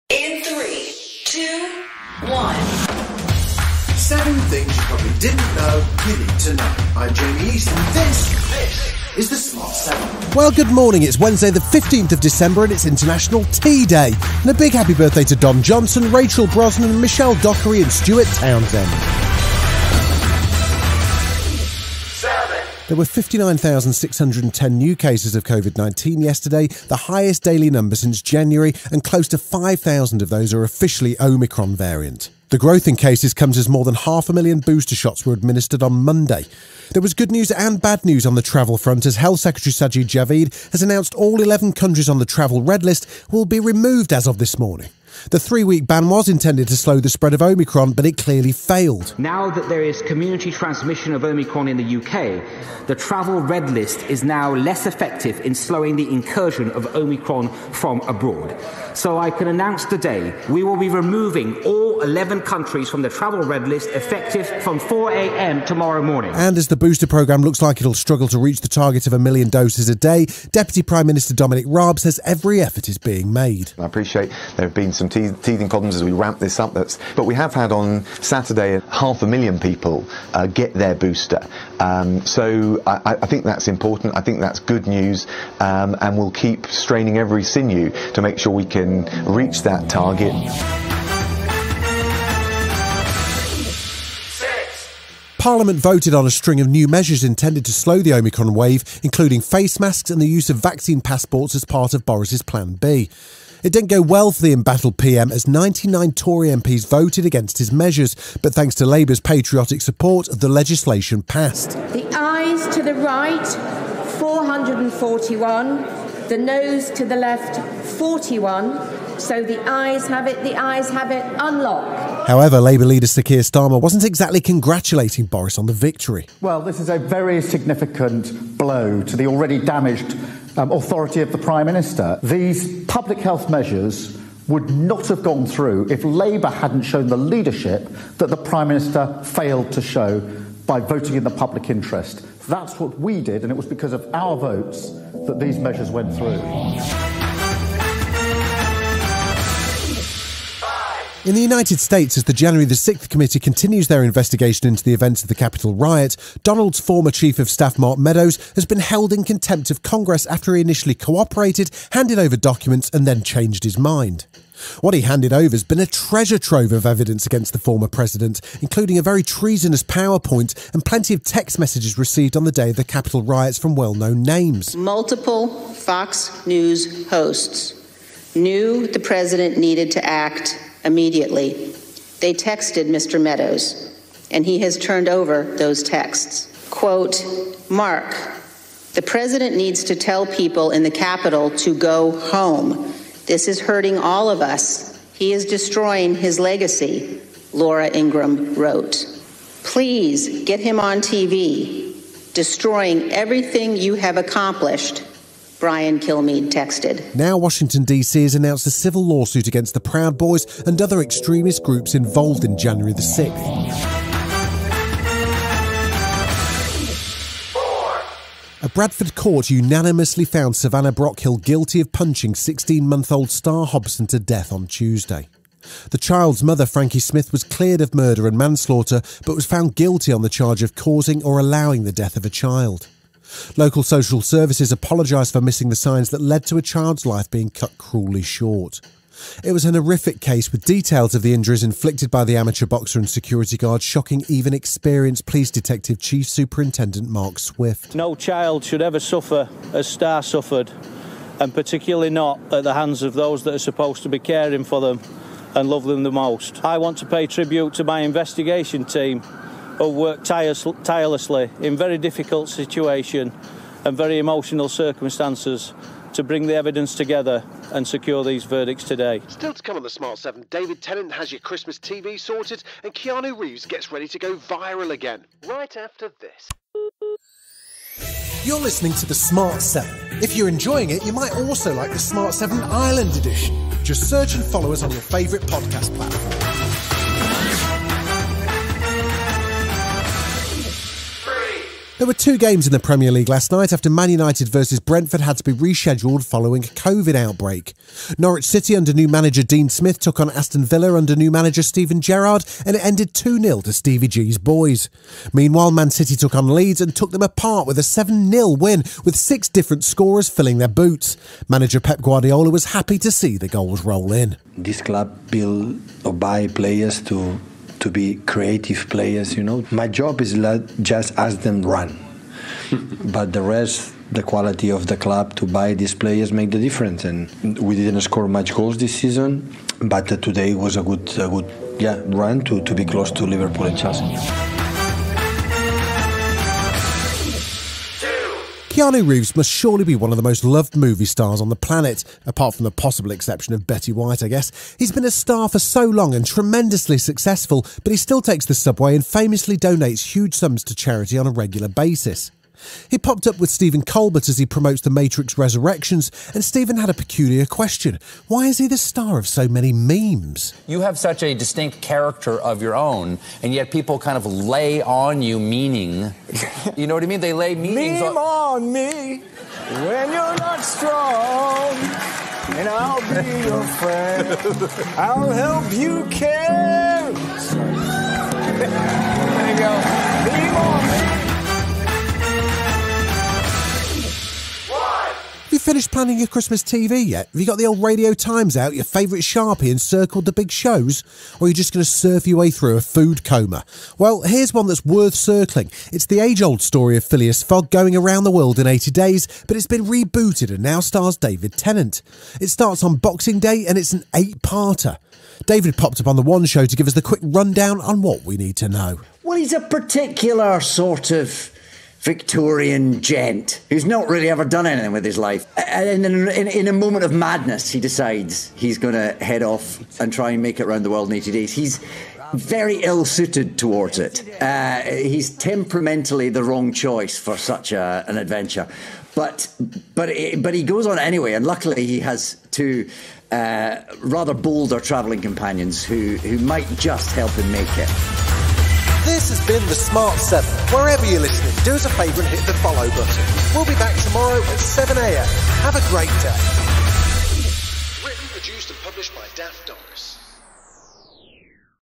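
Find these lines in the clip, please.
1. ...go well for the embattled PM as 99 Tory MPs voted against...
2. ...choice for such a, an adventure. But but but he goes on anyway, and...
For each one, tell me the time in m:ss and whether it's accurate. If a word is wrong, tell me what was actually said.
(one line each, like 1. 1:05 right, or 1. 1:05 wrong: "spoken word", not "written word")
1. 1:43 right
2. 7:06 right.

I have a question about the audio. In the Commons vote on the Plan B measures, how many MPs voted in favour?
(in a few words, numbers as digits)
441.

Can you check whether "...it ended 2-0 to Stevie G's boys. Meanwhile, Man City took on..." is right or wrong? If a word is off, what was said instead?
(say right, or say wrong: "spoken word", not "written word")
right.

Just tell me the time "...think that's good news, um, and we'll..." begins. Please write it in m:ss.
1:24.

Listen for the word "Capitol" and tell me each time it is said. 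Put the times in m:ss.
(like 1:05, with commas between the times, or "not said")
2:35, 2:52, 3:10.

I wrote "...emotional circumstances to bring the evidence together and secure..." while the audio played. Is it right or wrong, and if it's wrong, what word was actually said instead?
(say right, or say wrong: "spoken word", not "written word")
right.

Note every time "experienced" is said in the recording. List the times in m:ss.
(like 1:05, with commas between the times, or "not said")
4:04.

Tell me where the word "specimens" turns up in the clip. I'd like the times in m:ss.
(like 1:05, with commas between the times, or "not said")
not said.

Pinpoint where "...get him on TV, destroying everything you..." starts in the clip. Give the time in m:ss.
3:20.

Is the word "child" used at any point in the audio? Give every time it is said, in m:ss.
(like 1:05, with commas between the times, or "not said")
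3:45, 3:52, 3:56, 4:08.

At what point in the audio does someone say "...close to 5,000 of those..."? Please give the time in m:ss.
0:29.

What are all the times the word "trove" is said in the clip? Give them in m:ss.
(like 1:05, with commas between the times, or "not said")
2:46.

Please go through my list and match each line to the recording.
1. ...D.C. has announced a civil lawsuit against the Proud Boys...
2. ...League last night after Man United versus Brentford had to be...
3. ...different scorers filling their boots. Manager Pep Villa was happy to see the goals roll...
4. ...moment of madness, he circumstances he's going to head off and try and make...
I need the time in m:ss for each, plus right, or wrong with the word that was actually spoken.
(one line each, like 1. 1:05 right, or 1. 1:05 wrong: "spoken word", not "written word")
1. 3:27 right
2. 4:53 right
3. 5:09 wrong: "Guardiola", not "Villa"
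4. 6:56 wrong: "decides", not "circumstances".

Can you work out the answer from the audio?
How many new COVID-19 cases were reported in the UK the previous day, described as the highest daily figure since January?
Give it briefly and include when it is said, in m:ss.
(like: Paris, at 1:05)
59,610, at 0:23.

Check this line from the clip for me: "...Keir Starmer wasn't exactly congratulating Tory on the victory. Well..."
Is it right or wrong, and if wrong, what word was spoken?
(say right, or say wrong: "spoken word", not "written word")
wrong: "Boris", not "Tory".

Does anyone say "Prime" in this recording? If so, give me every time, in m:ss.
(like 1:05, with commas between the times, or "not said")
1:10, 2:11, 2:18.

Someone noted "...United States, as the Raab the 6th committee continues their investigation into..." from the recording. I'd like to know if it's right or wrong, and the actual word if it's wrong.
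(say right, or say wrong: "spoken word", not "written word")
wrong: "January", not "Raab".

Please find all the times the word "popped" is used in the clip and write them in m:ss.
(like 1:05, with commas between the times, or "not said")
5:52, 6:45.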